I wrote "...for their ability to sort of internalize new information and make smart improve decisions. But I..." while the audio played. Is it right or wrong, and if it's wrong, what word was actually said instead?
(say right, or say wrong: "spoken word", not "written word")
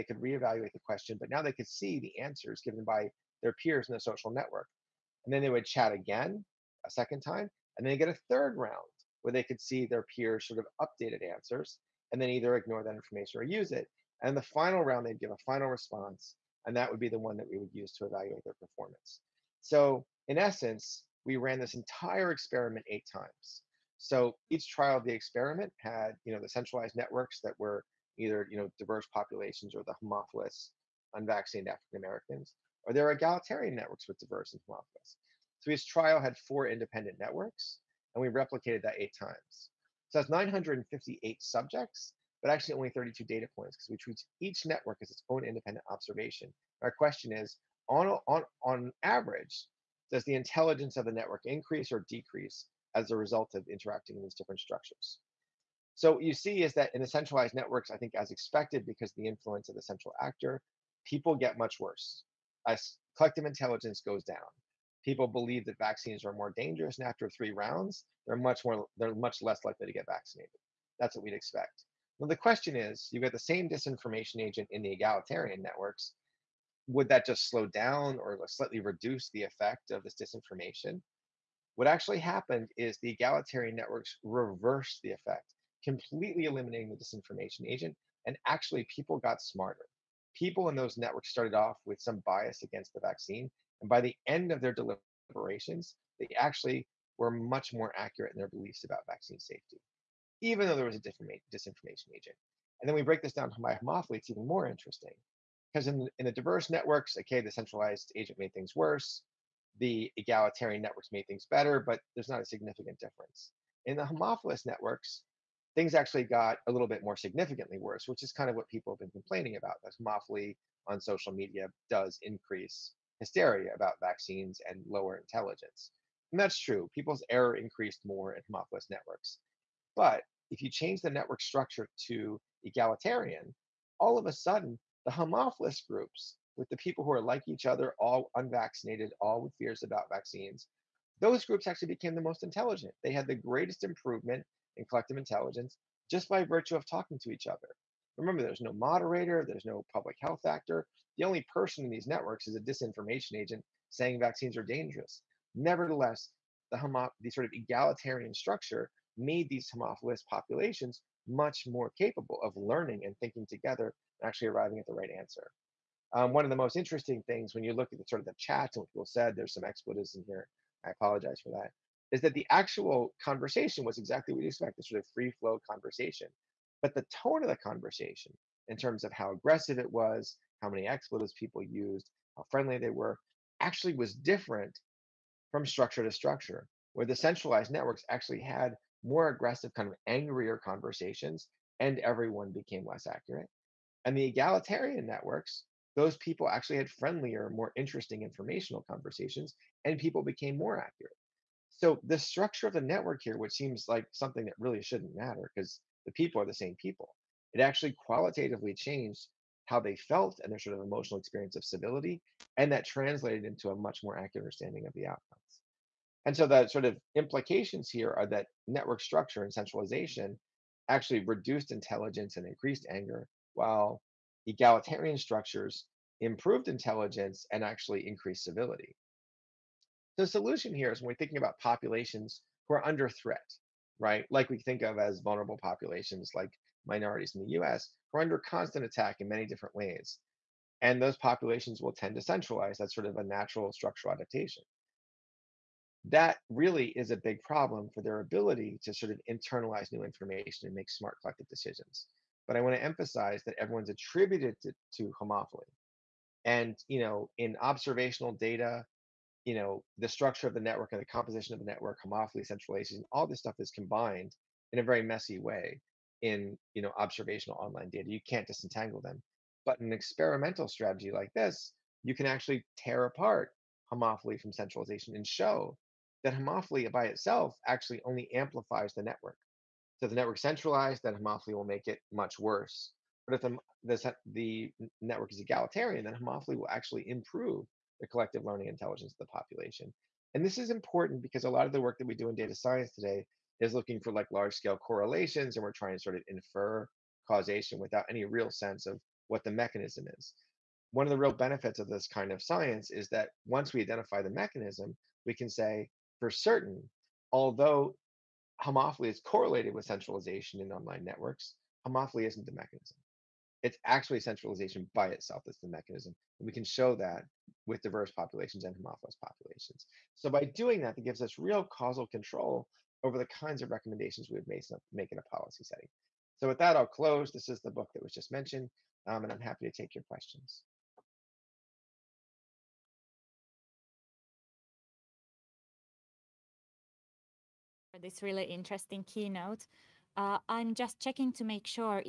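wrong: "collective", not "improve".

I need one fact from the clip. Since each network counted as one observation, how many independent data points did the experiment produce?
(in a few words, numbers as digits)
32.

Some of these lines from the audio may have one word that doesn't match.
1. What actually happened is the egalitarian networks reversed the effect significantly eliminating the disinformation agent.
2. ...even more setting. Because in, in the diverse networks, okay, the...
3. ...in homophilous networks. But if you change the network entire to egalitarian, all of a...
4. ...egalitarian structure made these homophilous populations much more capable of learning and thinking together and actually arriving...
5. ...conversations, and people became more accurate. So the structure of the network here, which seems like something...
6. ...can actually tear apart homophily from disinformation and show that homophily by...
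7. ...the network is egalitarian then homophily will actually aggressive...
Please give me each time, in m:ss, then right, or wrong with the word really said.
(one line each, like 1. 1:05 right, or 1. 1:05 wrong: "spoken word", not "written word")
1. 1:21 wrong: "completely", not "significantly"
2. 1:44 wrong: "interesting", not "setting"
3. 2:08 wrong: "structure", not "entire"
4. 2:37 right
5. 3:18 right
6. 4:32 wrong: "centralization", not "disinformation"
7. 4:44 wrong: "improve", not "aggressive".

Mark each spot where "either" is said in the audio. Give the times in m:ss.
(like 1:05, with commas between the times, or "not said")
0:12, 0:28.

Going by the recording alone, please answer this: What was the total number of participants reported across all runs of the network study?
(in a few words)
958.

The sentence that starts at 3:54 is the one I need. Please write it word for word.
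Like we think of as vulnerable populations like minorities in the US, who are under constant attack in many different ways.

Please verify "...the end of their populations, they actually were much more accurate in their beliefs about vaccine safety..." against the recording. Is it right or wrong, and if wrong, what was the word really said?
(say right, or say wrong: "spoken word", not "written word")
wrong: "deliberations", not "populations".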